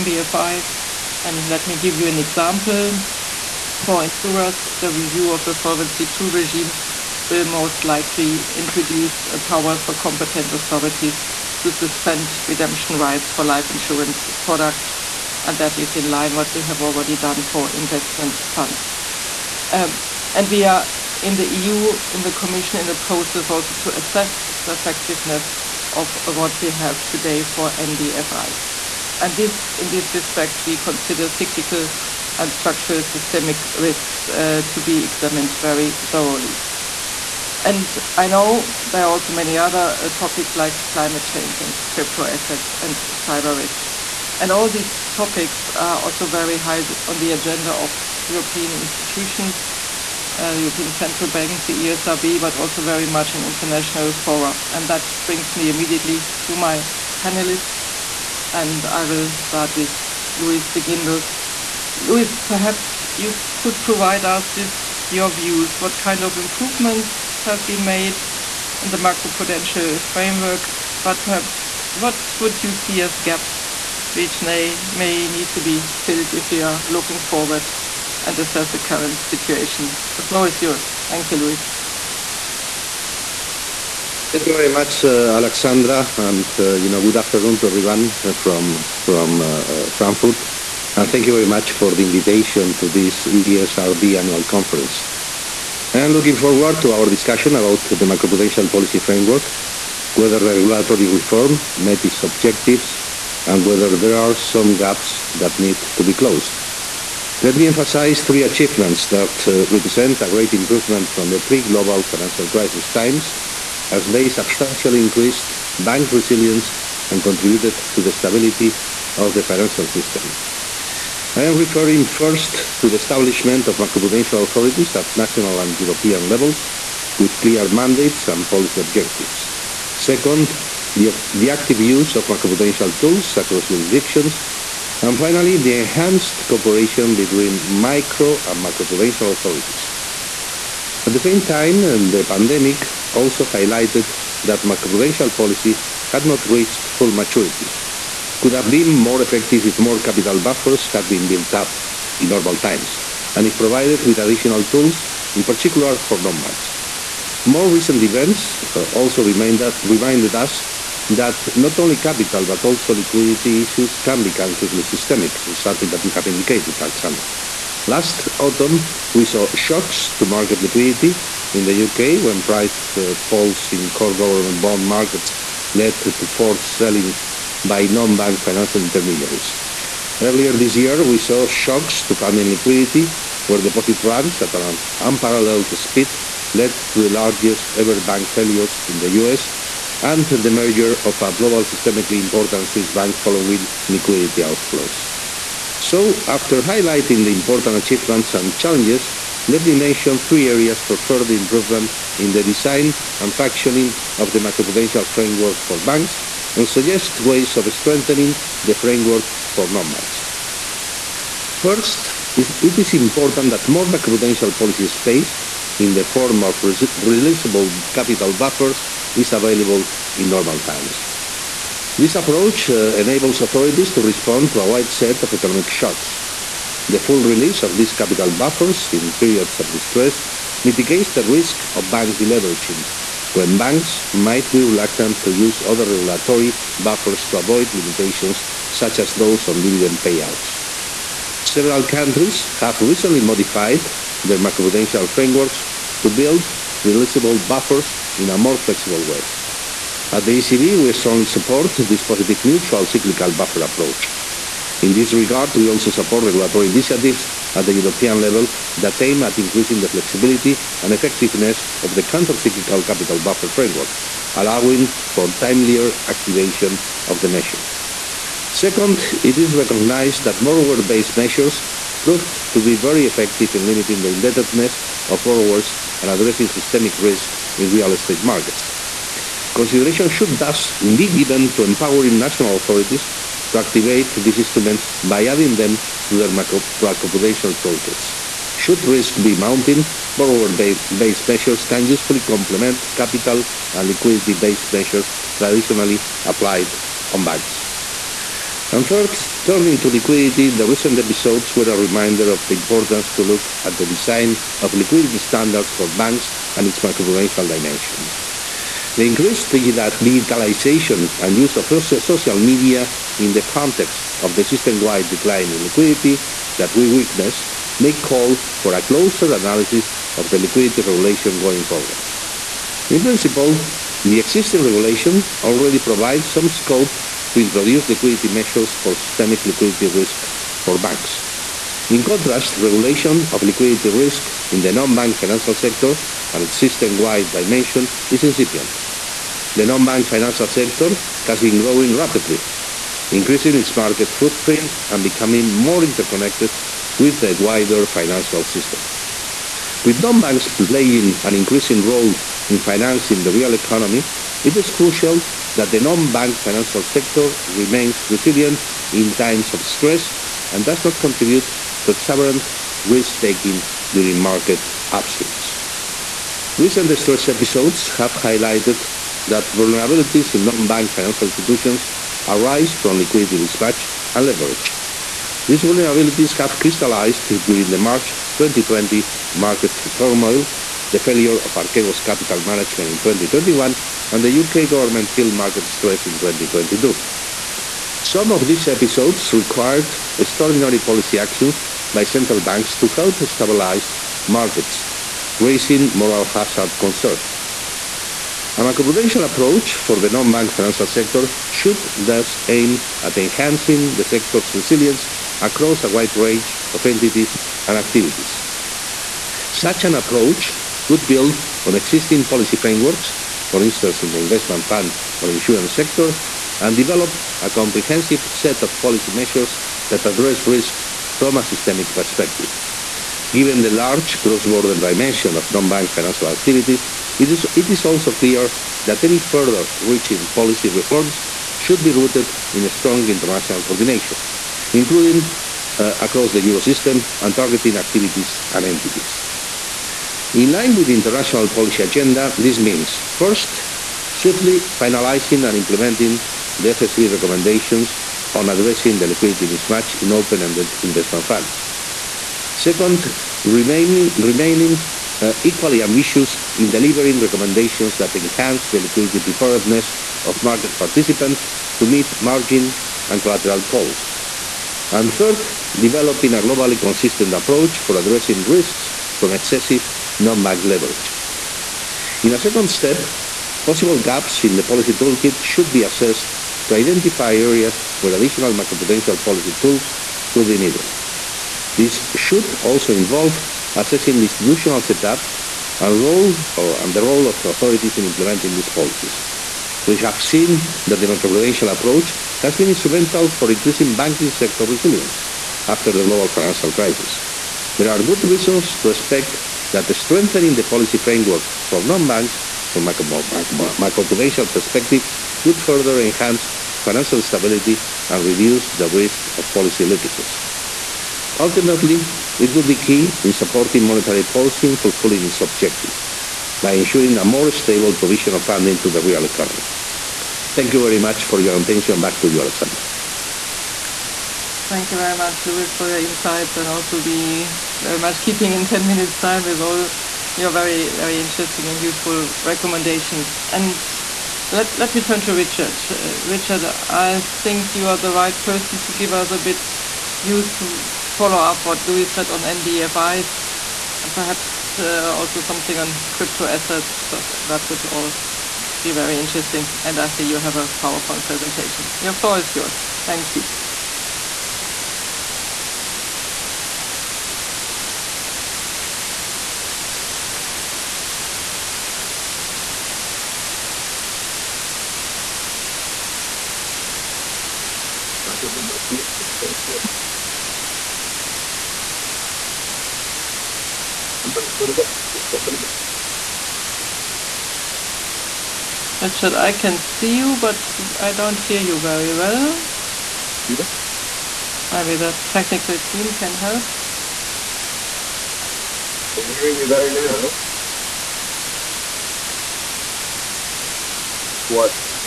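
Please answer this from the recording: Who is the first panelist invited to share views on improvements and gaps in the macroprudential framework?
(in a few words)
Luis de Guindos.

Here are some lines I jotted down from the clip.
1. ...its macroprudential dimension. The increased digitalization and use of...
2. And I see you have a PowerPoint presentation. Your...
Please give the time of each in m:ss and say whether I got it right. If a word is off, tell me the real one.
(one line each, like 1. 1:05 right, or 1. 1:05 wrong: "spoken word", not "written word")
1. 5:06 right
2. 9:09 right.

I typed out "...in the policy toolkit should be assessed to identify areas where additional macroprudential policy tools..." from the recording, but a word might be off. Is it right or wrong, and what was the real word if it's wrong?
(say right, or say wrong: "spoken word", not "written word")
right.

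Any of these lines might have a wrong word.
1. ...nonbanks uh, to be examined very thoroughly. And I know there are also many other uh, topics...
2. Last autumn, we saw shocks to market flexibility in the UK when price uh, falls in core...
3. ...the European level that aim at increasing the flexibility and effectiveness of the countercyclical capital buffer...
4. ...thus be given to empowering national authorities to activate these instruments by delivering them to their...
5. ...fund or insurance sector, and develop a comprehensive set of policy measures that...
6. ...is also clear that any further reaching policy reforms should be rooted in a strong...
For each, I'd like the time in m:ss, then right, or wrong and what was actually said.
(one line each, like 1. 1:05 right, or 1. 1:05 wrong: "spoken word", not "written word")
1. 0:33 wrong: "risks", not "nonbanks"
2. 2:47 wrong: "liquidity", not "flexibility"
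3. 4:17 right
4. 4:40 wrong: "adding", not "delivering"
5. 6:54 right
6. 7:07 right.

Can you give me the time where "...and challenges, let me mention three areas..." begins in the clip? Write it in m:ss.
3:18.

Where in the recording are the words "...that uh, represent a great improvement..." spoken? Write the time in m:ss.
1:49.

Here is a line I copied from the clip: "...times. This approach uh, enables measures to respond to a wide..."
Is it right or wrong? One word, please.
wrong.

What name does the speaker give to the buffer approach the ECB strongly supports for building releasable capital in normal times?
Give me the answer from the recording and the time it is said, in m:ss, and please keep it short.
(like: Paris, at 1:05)
positive neutral cyclical buffer, at 4:12.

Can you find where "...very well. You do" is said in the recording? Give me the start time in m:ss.
9:41.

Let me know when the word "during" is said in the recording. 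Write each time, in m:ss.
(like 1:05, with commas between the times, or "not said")
6:03, 6:17.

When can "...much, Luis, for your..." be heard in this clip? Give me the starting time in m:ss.
8:45.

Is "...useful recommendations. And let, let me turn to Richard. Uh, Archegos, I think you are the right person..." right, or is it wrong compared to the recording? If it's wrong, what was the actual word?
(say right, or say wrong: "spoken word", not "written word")
wrong: "Richard", not "Archegos".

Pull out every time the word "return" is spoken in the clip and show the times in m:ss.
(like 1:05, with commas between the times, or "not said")
not said.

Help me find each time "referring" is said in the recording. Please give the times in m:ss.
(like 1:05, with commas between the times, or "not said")
2:01.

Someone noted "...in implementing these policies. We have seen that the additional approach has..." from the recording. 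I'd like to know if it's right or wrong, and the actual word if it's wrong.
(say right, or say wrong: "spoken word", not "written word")
wrong: "macroprudential", not "additional".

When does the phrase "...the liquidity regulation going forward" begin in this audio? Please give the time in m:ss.
5:20.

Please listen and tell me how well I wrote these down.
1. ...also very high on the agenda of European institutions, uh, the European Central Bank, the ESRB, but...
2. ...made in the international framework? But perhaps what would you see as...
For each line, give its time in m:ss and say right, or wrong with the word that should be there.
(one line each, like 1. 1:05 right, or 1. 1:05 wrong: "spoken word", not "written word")
1. 0:45 right
2. 1:07 wrong: "macroprudential", not "international".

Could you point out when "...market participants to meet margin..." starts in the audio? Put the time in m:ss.
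7:40.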